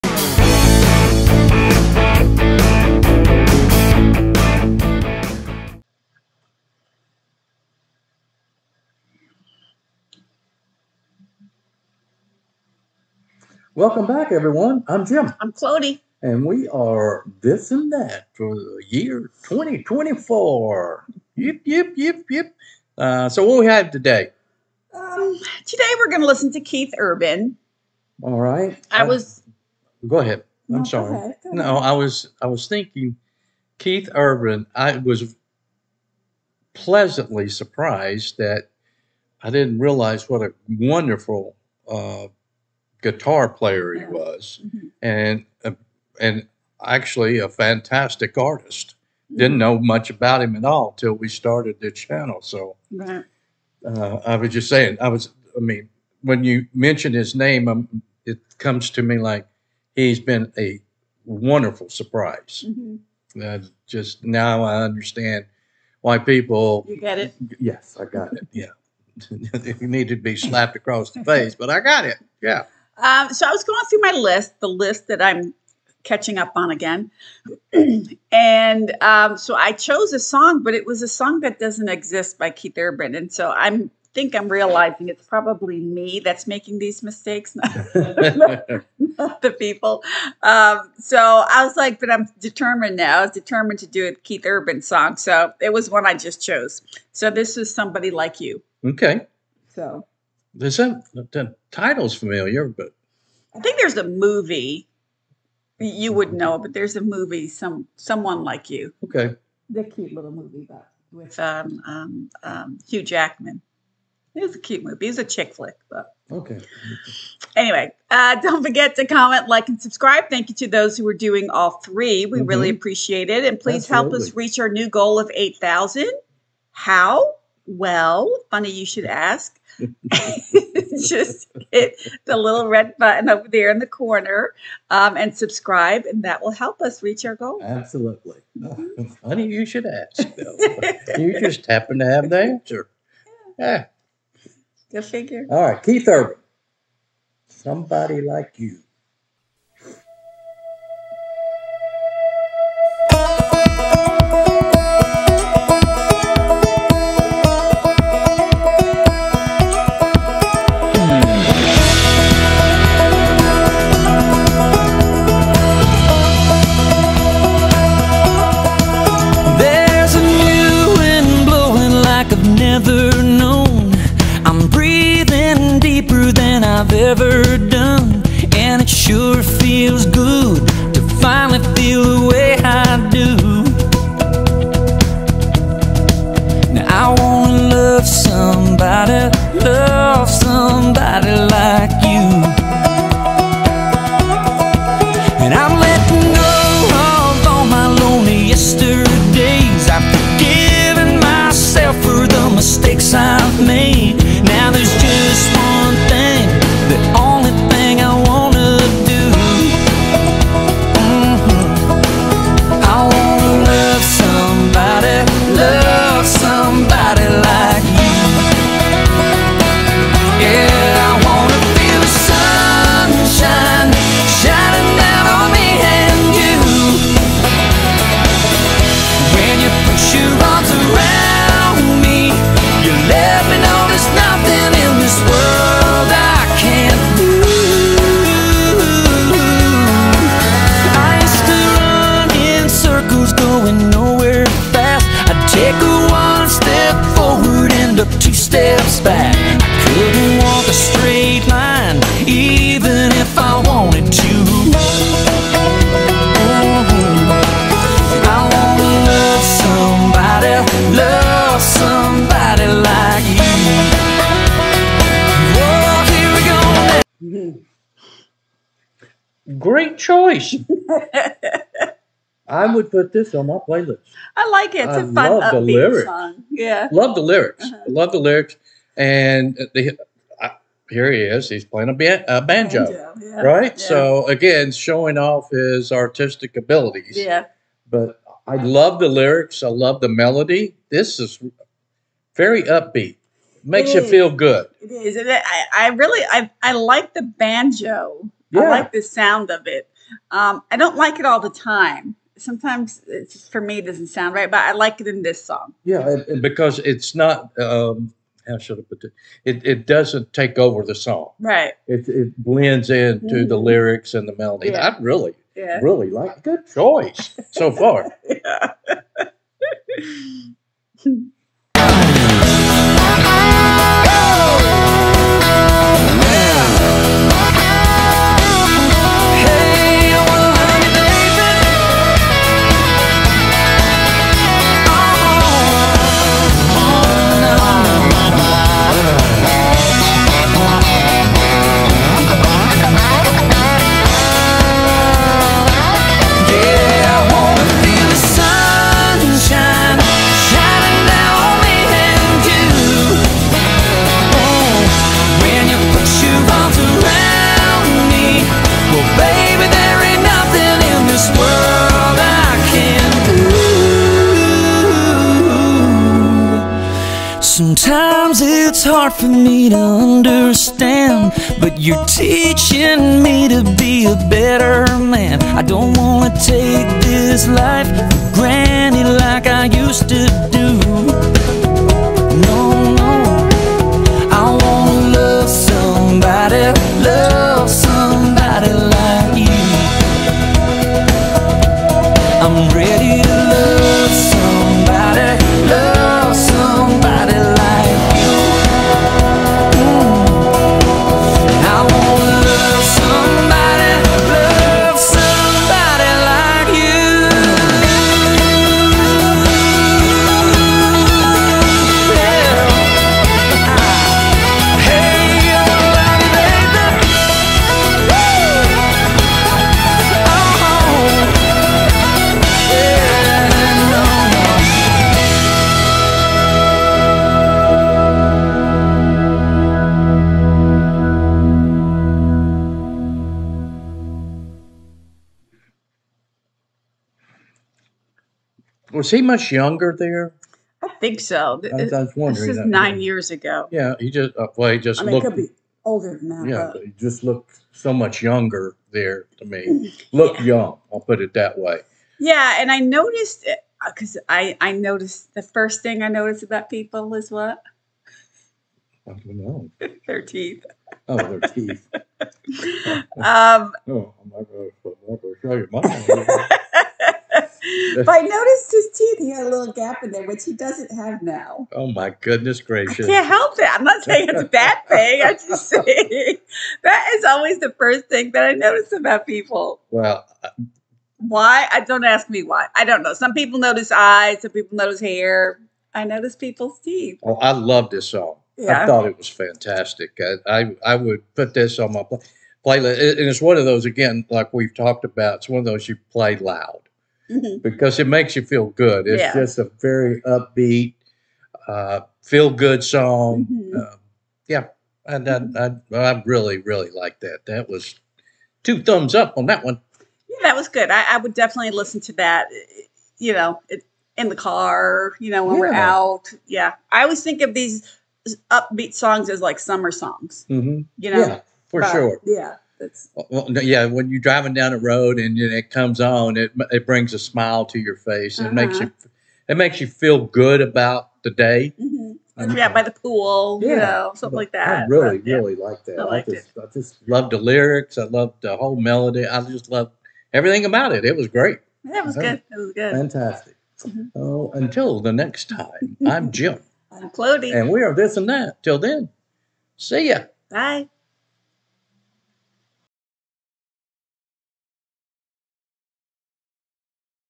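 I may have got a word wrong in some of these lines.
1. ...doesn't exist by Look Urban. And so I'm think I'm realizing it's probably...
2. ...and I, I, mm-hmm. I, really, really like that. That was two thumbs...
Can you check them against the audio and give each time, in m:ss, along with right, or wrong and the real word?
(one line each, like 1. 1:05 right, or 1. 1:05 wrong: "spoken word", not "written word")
1. 1:21 wrong: "Keith", not "Look"
2. 8:25 right.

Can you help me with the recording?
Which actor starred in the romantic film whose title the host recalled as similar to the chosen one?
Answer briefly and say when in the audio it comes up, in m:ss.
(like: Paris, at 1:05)
Hugh Jackman, at 1:52.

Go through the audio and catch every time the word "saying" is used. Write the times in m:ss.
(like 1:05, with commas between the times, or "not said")
0:54, 7:54.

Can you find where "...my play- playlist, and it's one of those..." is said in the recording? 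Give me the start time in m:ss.
8:11.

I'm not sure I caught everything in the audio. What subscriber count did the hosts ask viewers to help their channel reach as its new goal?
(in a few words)
8,000.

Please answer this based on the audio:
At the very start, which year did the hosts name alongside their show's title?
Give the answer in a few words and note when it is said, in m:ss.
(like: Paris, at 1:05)
2024, at 0:19.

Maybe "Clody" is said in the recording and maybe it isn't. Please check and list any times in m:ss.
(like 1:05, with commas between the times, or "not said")
0:15, 9:07.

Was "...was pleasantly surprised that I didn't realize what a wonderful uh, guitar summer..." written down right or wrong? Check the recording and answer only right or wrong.
wrong.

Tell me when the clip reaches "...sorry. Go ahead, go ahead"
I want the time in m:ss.
0:30.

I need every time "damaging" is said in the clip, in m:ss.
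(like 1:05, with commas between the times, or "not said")
not said.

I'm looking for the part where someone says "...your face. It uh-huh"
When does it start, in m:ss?
8:47.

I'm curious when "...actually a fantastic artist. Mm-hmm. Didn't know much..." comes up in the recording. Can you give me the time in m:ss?
0:46.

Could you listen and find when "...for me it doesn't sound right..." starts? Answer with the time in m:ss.
5:03.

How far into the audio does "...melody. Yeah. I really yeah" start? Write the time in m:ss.
5:14.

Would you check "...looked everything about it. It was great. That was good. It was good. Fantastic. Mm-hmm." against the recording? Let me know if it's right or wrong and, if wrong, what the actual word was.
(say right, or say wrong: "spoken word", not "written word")
wrong: "loved", not "looked".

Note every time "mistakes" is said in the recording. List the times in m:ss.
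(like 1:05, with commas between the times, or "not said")
1:27.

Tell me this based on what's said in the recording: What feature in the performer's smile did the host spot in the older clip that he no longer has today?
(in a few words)
A little gap.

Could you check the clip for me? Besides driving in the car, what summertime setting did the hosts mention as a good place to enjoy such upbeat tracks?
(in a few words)
By the pool.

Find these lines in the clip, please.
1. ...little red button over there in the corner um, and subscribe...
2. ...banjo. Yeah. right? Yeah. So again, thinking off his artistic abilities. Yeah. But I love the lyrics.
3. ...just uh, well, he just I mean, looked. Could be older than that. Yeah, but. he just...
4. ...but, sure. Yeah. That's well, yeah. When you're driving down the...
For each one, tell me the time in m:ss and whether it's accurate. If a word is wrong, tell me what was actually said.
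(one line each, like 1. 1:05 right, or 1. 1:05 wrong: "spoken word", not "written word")
1. 2:12 right
2. 4:42 wrong: "showing", not "thinking"
3. 7:24 right
4. 8:41 right.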